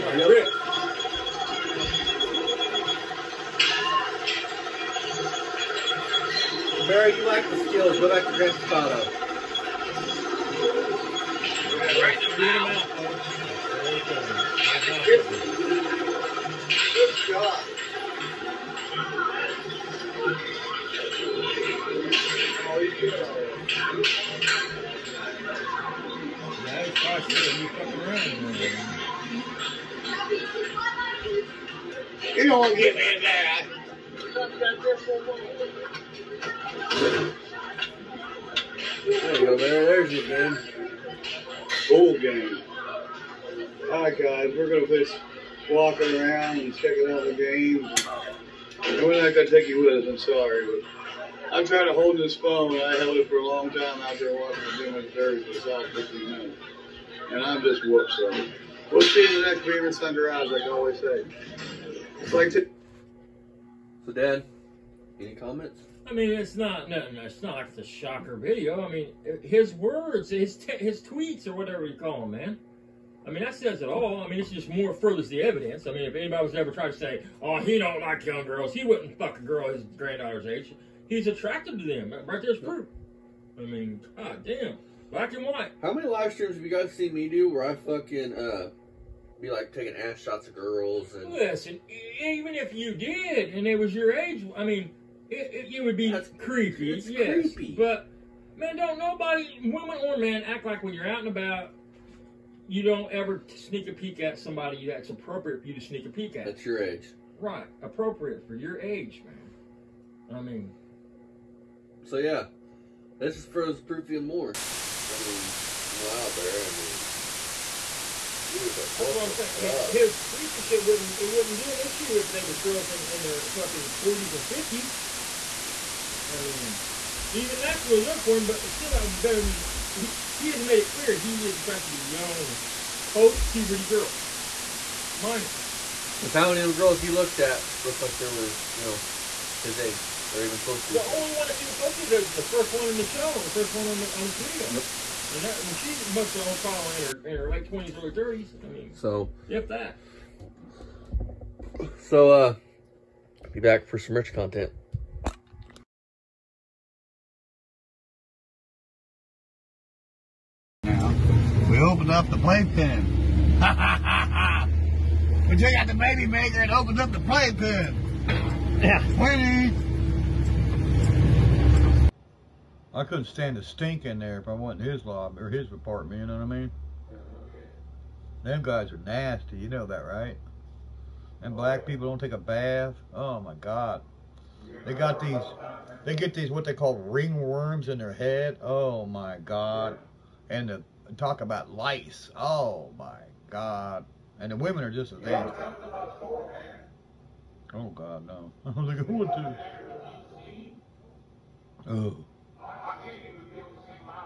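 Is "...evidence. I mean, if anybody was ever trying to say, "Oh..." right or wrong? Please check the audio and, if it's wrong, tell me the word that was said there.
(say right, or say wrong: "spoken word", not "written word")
right.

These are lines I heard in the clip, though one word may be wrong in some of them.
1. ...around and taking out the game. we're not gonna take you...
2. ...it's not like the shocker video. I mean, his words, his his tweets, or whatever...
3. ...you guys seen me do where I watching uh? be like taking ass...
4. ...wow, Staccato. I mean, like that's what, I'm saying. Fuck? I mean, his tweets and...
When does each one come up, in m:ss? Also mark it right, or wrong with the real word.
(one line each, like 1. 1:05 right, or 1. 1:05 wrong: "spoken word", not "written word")
1. 0:45 wrong: "checking", not "taking"
2. 1:07 right
3. 1:26 wrong: "fucking", not "watching"
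4. 1:55 wrong: "Bear", not "Staccato".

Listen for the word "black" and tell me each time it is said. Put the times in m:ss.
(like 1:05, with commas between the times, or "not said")
1:25, 3:01.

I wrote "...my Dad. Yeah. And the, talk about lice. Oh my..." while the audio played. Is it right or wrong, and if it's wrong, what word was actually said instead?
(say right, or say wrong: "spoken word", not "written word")
wrong: "God", not "Dad".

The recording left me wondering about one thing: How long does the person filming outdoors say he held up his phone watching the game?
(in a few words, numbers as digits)
15 minutes.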